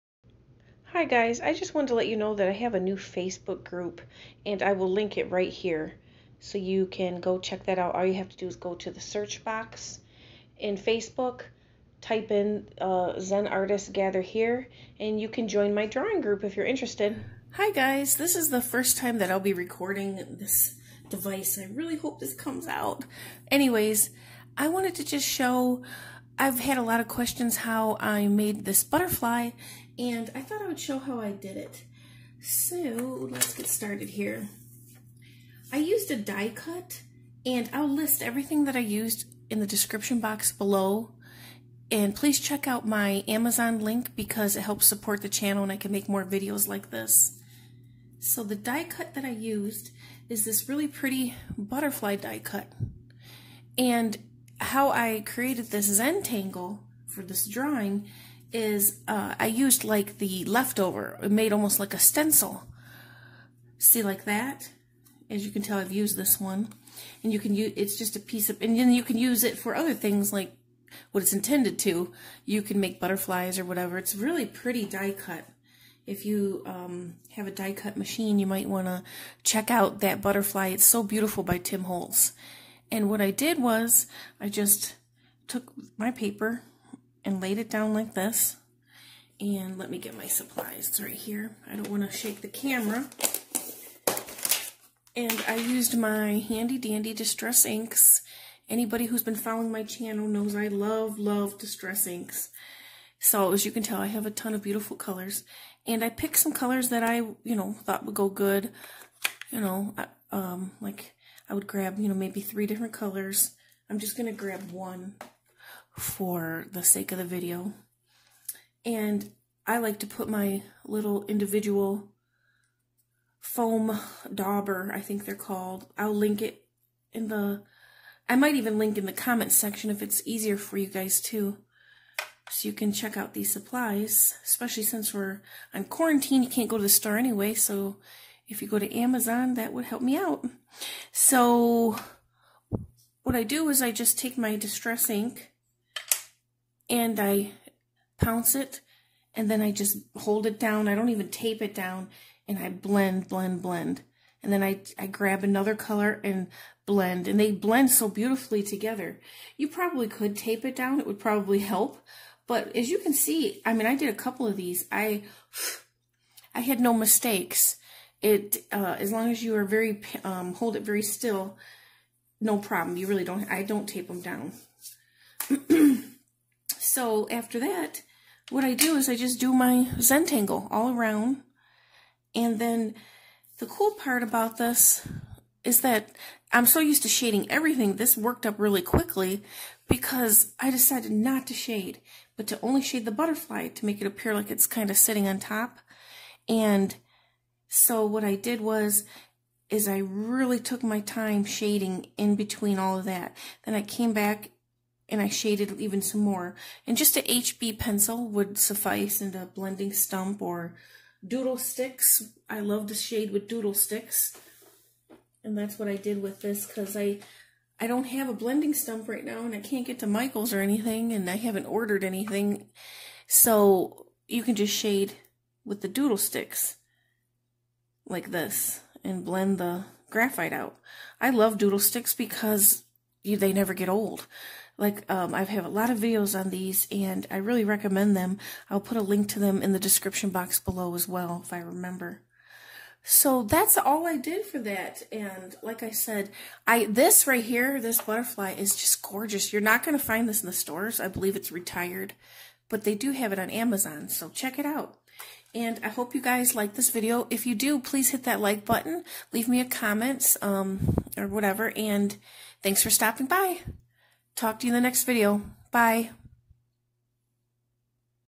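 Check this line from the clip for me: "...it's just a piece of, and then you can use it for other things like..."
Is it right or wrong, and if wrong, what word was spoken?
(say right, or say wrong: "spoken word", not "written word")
right.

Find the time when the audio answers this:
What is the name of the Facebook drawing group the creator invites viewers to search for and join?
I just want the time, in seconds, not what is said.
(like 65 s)
13 s.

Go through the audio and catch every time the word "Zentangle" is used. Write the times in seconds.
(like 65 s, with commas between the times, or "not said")
55 s, 179 s.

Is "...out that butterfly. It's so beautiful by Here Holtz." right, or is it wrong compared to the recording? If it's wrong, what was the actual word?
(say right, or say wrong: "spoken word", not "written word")
wrong: "Tim", not "Here".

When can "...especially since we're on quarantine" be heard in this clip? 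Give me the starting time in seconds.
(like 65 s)
134 s.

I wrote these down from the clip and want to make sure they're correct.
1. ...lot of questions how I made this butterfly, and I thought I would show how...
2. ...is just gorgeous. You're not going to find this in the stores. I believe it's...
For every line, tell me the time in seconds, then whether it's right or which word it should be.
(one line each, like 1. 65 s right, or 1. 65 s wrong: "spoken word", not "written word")
1. 26 s right
2. 248 s right.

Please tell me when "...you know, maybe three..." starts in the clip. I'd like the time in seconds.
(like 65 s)
111 s.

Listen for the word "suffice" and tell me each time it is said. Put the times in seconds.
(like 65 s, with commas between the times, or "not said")
208 s.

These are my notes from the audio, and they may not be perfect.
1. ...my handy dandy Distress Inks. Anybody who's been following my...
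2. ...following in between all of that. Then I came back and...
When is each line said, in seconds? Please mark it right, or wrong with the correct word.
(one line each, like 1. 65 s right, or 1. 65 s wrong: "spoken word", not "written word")
1. 95 s right
2. 201 s wrong: "shading", not "following".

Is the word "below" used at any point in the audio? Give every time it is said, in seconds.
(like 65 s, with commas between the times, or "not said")
40 s, 240 s.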